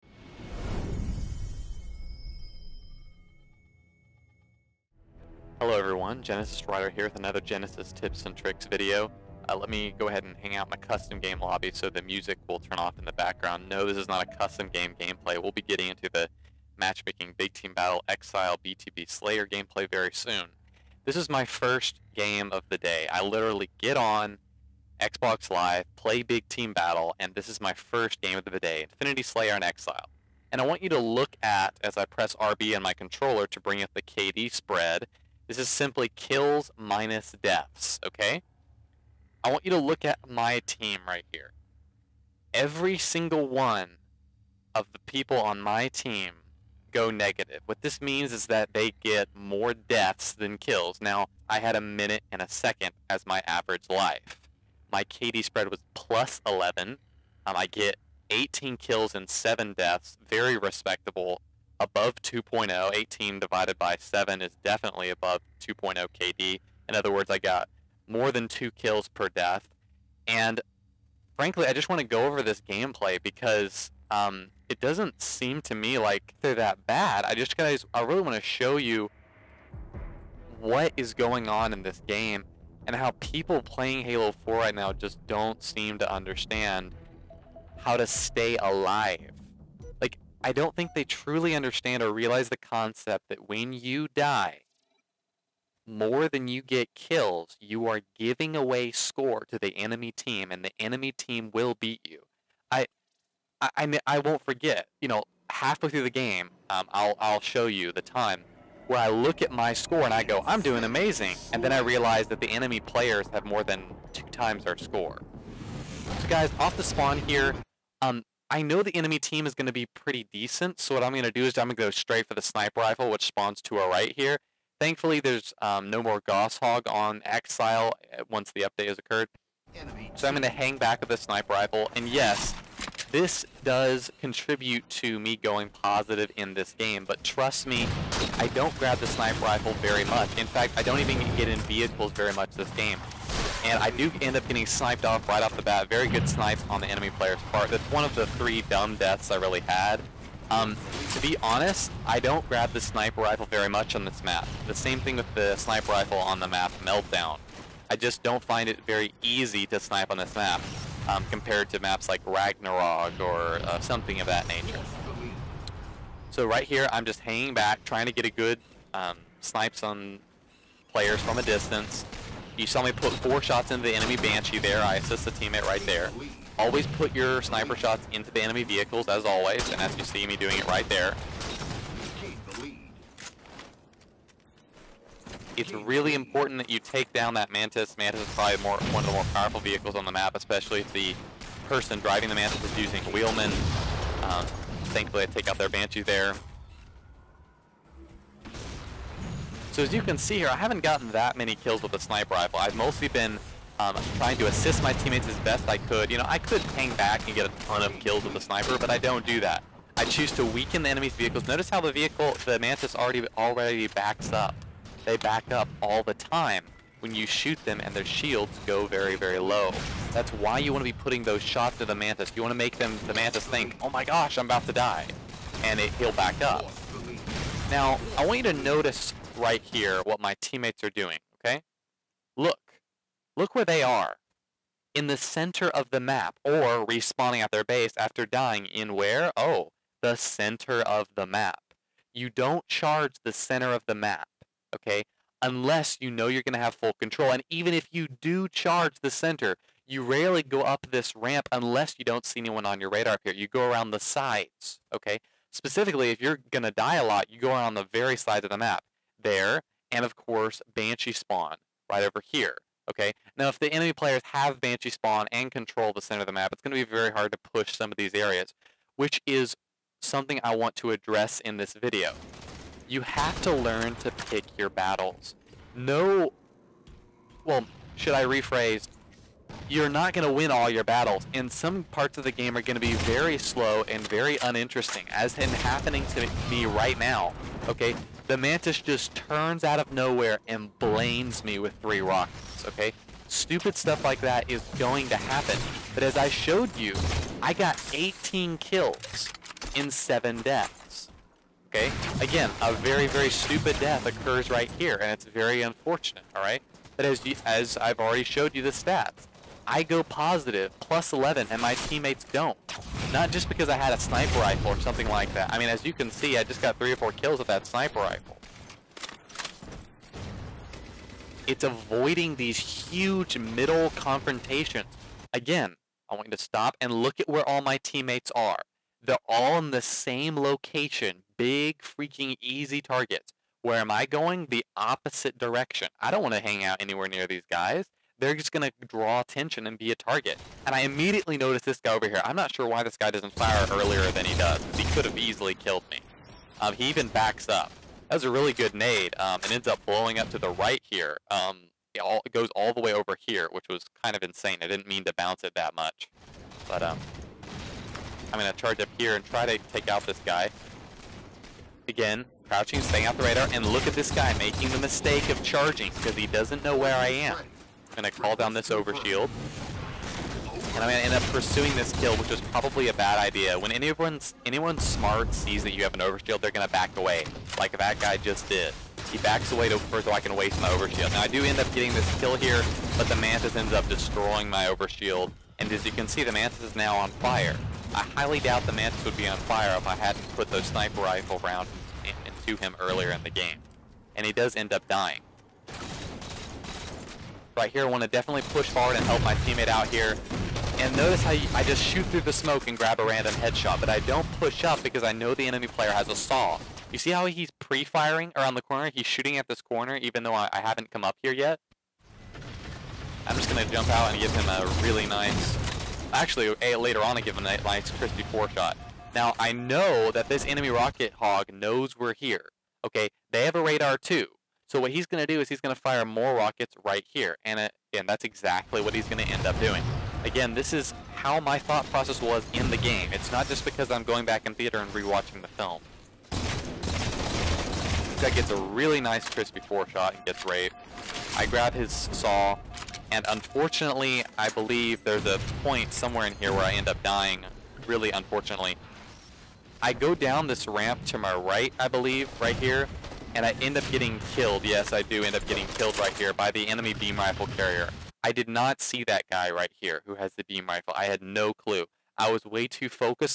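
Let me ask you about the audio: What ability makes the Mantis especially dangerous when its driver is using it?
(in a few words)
Wheelman.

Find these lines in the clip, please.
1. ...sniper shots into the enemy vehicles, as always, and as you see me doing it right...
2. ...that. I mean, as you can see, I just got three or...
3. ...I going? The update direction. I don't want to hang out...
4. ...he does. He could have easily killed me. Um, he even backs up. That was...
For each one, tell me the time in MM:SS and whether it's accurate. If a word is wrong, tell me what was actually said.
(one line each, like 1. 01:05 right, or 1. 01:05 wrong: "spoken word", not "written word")
1. 02:57 right
2. 05:15 right
3. 05:33 wrong: "opposite", not "update"
4. 05:44 right.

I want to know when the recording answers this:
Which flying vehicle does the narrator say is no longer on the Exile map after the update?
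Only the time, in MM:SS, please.
02:06.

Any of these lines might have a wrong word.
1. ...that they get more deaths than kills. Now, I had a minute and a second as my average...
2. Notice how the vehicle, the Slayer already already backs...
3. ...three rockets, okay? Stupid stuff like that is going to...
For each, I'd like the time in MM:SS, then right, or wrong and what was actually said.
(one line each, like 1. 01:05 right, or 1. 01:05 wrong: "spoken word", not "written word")
1. 00:48 right
2. 03:31 wrong: "Mantis", not "Slayer"
3. 04:51 right.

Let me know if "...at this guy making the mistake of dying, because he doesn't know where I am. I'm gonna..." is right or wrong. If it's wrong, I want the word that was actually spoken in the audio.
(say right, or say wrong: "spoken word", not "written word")
wrong: "charging", not "dying".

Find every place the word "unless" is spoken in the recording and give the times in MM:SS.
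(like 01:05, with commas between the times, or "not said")
04:05, 04:11.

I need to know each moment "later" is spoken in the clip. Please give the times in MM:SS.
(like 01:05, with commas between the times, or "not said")
06:56.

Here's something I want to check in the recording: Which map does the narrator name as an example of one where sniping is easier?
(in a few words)
Ragnarok.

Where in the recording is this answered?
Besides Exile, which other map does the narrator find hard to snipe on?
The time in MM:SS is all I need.
02:36.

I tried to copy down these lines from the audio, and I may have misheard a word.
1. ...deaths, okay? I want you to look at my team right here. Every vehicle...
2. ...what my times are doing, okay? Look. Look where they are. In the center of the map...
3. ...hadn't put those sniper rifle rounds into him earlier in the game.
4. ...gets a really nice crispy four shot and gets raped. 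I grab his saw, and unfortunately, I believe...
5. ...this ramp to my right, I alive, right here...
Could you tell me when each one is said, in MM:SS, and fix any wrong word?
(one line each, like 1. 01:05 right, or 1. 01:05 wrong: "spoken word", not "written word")
1. 00:37 wrong: "single", not "vehicle"
2. 03:50 wrong: "teammates", not "times"
3. 06:29 right
4. 07:18 right
5. 07:30 wrong: "believe", not "alive".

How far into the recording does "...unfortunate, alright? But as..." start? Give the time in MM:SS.
05:05.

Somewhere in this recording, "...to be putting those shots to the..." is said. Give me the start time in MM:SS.
03:40.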